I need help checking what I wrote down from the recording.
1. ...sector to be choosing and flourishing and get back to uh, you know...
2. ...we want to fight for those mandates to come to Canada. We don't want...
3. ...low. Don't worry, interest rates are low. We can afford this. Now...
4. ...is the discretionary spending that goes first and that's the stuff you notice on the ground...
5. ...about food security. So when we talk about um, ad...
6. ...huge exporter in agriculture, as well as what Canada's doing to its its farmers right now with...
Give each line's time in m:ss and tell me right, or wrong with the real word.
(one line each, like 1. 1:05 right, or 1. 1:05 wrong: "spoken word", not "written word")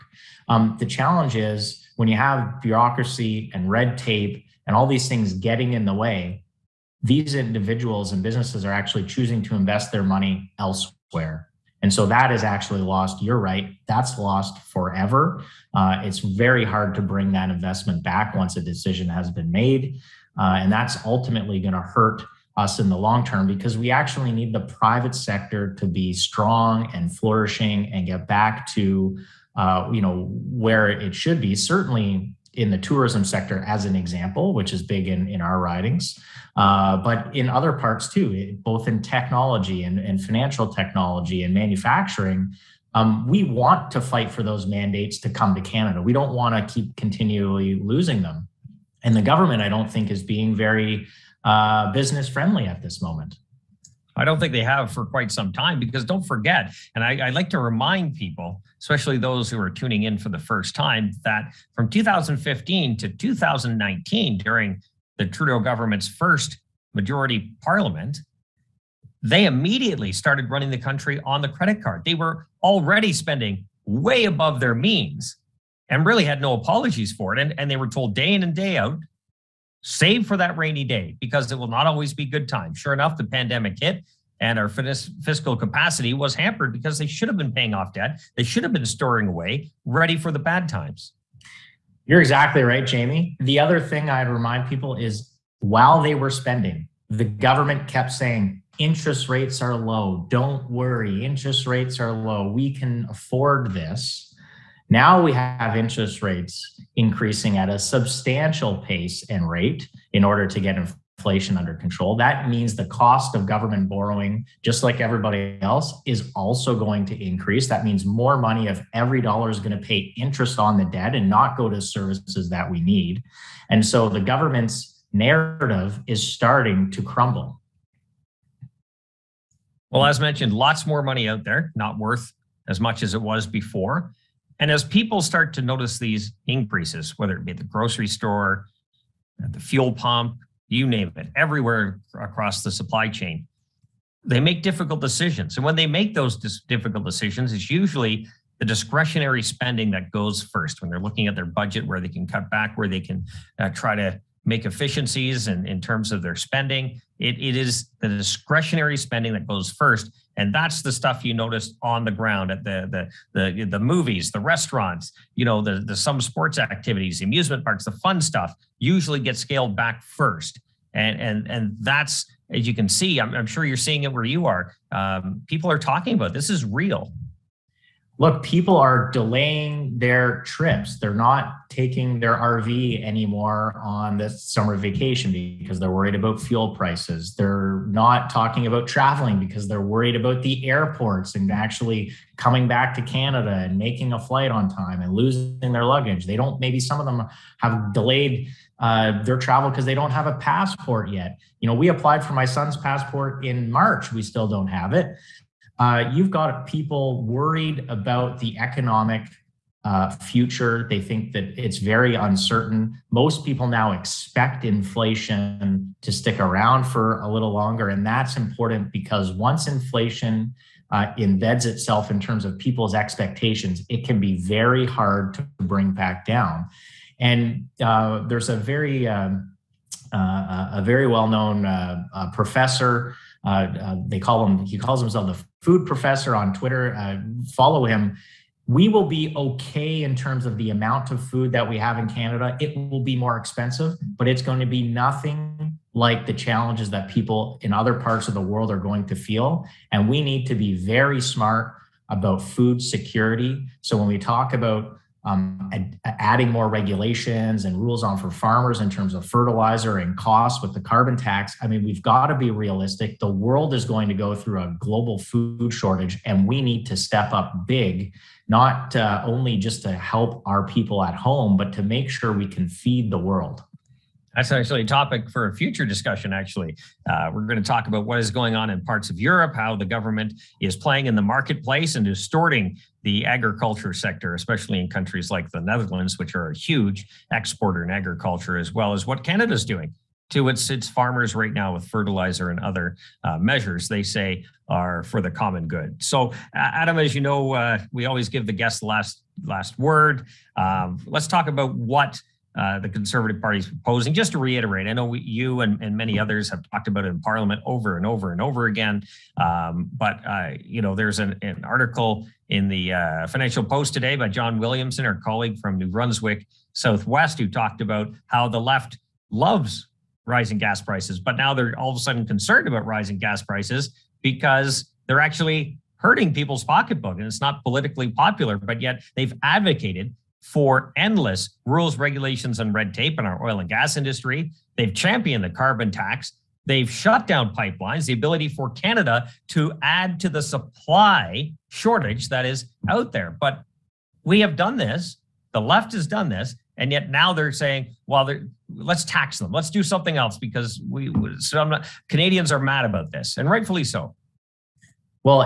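1. 0:25 wrong: "strong", not "choosing"
2. 0:43 right
3. 1:39 right
4. 2:37 right
5. 4:12 right
6. 4:46 right.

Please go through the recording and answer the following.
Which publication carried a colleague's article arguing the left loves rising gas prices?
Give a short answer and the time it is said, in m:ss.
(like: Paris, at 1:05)
Financial Post, at 5:13.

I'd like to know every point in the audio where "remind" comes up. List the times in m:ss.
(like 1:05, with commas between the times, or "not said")
0:57, 1:34.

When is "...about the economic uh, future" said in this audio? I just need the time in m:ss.
3:27.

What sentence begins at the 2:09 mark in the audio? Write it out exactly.
Well, as mentioned, lots more money out there, not worth as much as it was before.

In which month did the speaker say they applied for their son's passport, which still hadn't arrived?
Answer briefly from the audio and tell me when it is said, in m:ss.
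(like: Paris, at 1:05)
March, at 3:23.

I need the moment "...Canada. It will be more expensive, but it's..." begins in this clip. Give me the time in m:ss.
4:02.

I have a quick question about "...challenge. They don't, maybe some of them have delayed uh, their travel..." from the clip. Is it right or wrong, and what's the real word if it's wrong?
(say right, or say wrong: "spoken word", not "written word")
wrong: "luggage", not "challenge".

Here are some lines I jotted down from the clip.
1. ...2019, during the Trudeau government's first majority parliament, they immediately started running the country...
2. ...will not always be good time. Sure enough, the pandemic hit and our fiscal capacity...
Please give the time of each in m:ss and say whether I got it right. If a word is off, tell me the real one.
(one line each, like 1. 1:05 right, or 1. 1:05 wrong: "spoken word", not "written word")
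1. 1:03 right
2. 1:21 right.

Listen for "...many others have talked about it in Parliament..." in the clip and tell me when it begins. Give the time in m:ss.
5:05.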